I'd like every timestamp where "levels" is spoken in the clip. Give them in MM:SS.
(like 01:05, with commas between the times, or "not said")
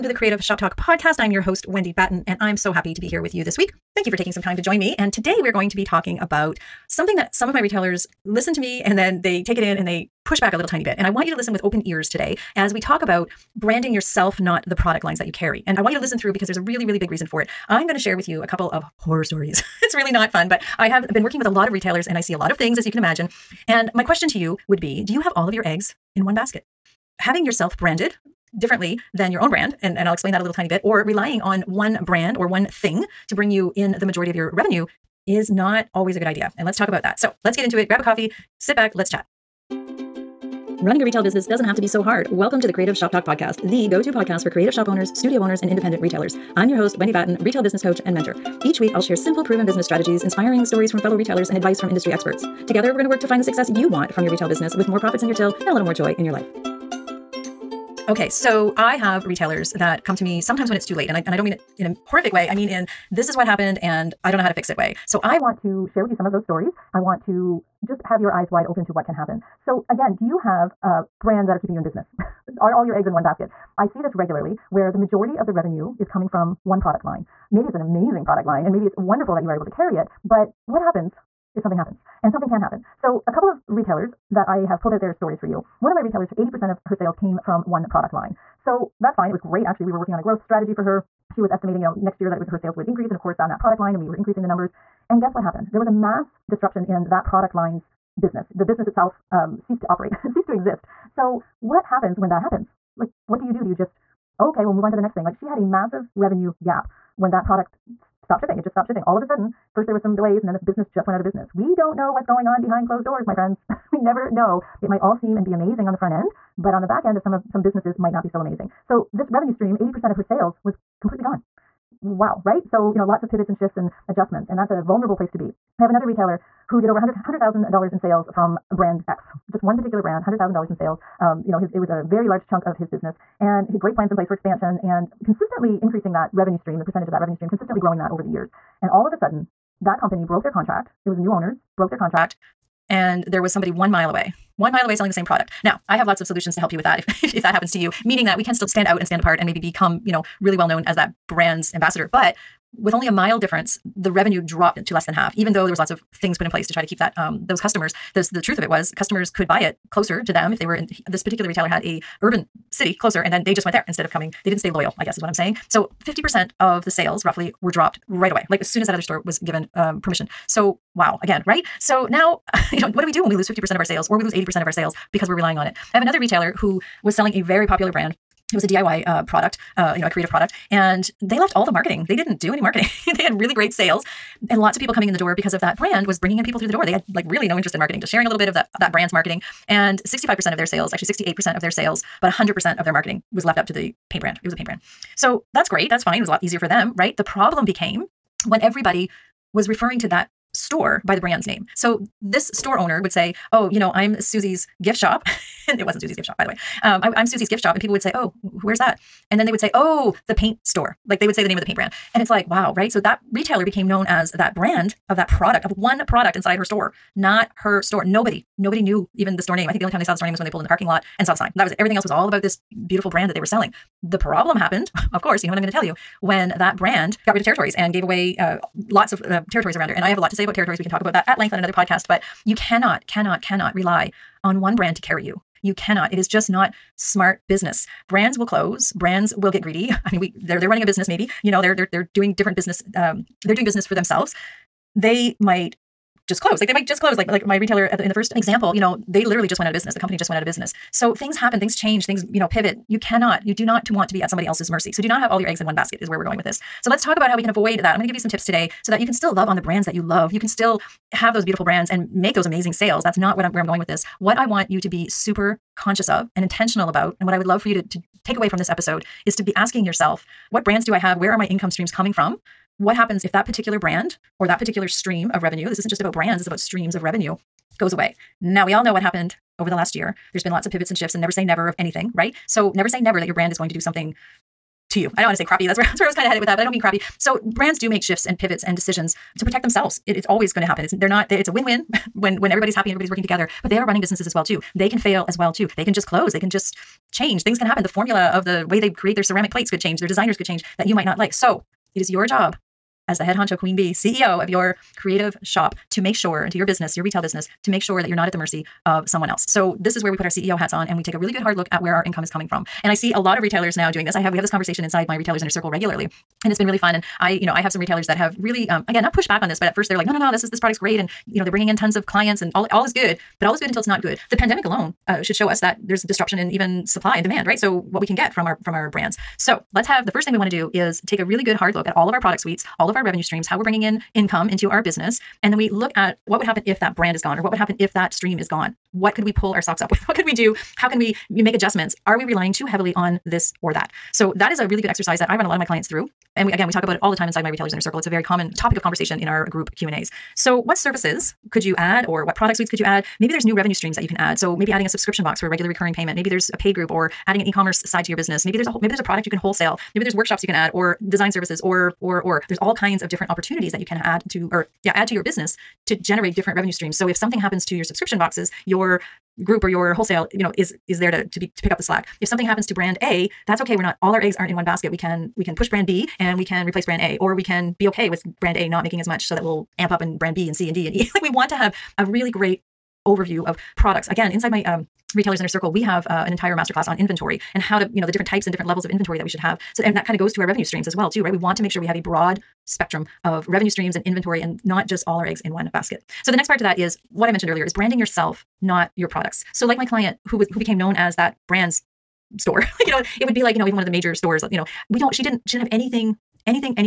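06:28.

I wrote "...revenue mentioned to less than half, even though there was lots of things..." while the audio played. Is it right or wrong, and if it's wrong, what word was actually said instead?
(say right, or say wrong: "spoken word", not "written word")
wrong: "dropped", not "mentioned".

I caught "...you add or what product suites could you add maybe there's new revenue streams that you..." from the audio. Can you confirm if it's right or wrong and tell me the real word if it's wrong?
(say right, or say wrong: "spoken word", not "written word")
right.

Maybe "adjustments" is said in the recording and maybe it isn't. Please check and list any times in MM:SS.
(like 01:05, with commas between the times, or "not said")
02:04, 05:41.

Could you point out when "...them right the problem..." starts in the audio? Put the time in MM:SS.
03:16.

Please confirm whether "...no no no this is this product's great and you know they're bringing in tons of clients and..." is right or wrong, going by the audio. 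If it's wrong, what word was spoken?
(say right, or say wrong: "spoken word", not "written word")
right.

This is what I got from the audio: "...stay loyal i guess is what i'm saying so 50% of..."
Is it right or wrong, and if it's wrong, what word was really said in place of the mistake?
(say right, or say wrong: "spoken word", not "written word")
right.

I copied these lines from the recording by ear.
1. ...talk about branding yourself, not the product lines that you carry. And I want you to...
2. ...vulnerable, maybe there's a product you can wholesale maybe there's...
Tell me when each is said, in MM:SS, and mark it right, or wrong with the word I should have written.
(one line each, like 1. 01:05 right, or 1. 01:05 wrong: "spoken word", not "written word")
1. 00:12 right
2. 05:58 wrong: "whole", not "vulnerable".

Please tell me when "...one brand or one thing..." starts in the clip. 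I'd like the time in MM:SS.
00:31.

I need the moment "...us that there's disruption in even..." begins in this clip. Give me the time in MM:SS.
05:25.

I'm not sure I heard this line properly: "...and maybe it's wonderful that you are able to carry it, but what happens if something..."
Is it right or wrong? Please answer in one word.
right.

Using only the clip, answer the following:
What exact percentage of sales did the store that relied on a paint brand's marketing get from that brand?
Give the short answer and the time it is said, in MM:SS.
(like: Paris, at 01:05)
68%, at 03:11.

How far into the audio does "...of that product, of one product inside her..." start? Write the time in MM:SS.
03:35.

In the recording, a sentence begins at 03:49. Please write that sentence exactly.
And I have a lot to say about territories.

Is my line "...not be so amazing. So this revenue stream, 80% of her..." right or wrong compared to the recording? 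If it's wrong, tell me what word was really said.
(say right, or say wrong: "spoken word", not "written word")
right.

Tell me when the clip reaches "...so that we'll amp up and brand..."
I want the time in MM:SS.
06:19.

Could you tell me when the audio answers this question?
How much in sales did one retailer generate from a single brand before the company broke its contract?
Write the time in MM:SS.
02:06.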